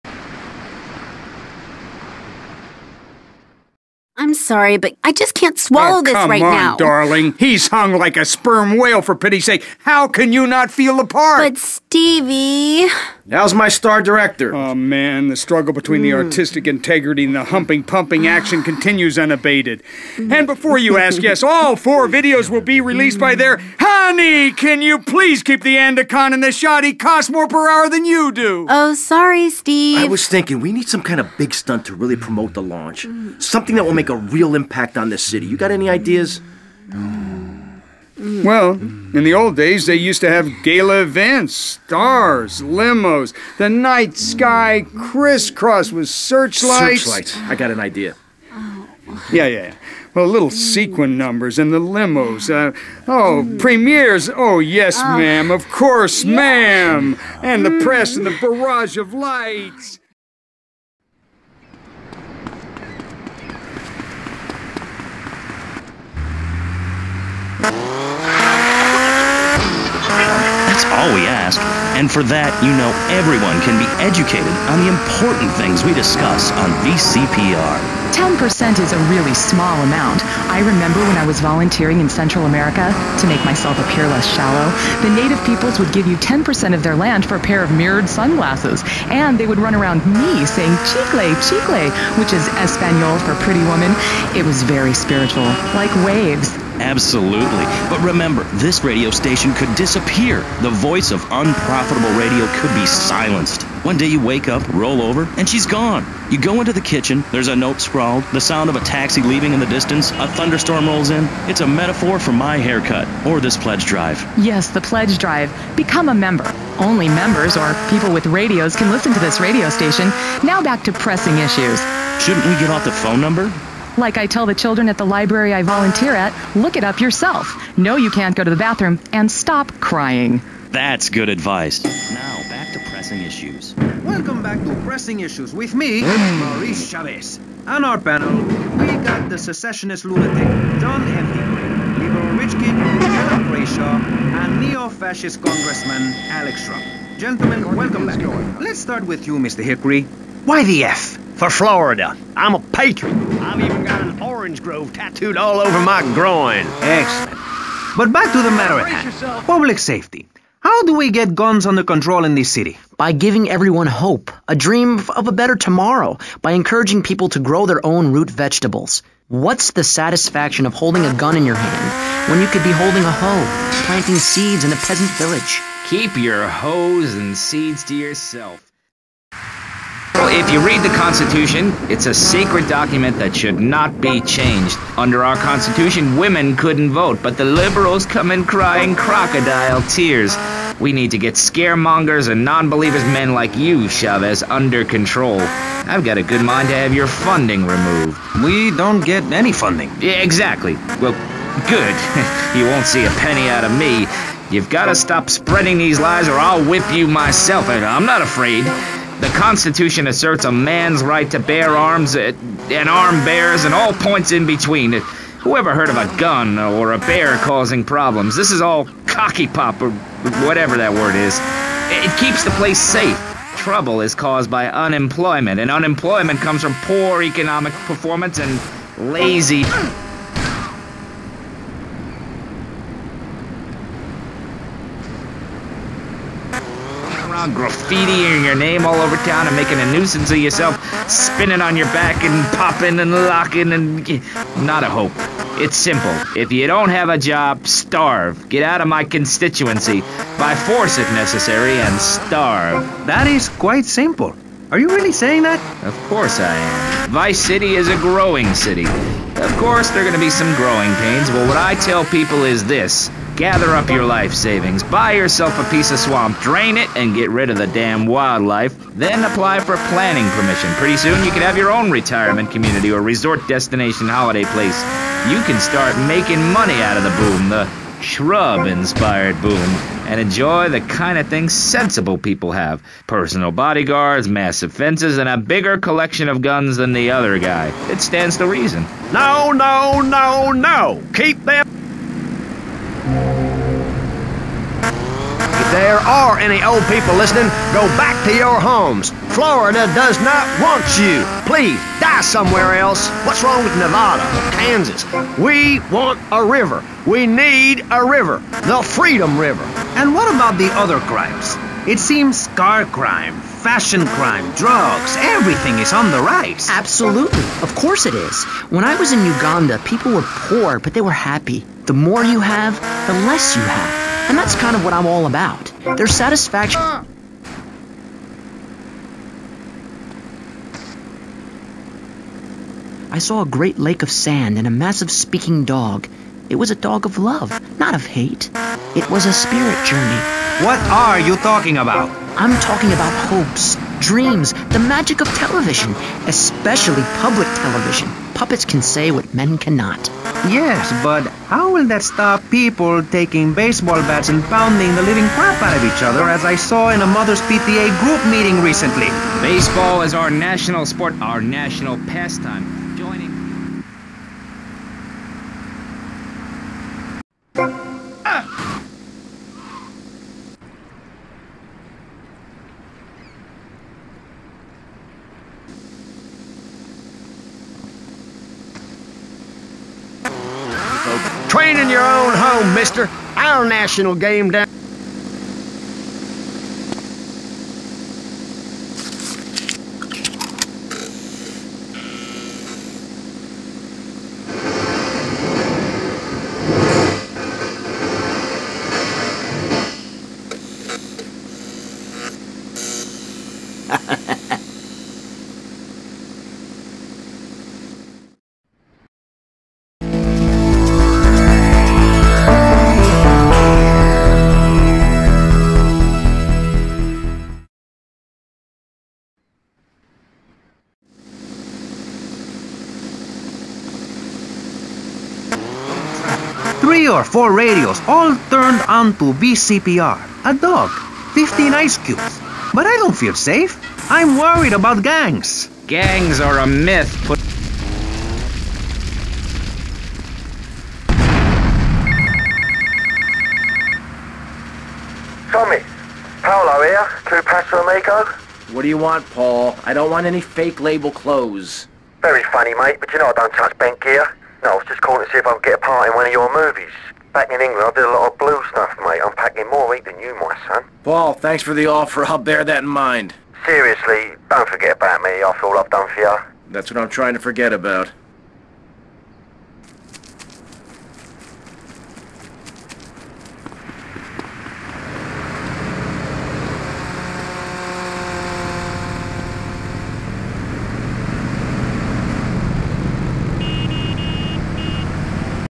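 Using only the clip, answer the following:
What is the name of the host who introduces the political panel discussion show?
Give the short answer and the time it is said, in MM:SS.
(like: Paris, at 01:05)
Maurice Chavez, at 02:16.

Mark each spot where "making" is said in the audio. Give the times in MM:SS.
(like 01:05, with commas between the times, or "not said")
03:59, 04:36.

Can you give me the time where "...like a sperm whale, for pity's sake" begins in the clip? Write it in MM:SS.
00:07.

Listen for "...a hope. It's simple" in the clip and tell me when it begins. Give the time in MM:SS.
04:04.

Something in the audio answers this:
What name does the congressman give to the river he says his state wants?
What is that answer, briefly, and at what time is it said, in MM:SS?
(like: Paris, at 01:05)
The Freedom River, at 05:08.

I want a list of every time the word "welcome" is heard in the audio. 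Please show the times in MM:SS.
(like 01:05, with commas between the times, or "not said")
02:14, 02:27.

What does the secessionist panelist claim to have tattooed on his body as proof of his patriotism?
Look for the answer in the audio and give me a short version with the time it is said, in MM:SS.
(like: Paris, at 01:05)
An orange grove, at 02:34.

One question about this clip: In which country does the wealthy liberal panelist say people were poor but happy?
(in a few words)
Uganda.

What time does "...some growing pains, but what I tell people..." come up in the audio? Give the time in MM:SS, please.
04:20.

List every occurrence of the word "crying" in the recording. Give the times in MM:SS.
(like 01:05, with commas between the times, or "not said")
02:09, 03:08.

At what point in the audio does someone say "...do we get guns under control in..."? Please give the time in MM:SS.
02:40.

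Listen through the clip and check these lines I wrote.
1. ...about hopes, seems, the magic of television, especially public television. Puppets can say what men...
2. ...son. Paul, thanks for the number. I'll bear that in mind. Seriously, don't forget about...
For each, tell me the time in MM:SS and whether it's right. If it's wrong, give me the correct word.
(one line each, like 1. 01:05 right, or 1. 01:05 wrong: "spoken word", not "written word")
1. 05:42 wrong: "dreams", not "seems"
2. 07:40 wrong: "offer", not "number".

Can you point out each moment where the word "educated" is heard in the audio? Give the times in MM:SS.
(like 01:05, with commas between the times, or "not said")
01:13.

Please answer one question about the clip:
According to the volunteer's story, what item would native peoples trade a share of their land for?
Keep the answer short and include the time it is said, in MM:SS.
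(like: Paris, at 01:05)
Mirrored sunglasses, at 01:27.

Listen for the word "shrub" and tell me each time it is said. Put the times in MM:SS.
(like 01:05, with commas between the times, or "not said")
02:26, 04:38.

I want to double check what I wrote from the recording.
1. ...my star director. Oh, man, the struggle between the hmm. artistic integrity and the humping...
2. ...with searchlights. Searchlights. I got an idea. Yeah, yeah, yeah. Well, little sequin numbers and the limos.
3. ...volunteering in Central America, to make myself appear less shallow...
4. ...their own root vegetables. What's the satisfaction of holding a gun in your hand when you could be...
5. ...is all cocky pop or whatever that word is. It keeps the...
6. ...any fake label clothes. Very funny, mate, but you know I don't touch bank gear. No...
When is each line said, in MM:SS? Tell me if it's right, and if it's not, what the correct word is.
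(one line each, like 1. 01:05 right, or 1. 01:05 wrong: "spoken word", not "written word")
1. 00:13 right
2. 00:45 right
3. 01:21 right
4. 02:47 right
5. 03:38 right
6. 07:30 right.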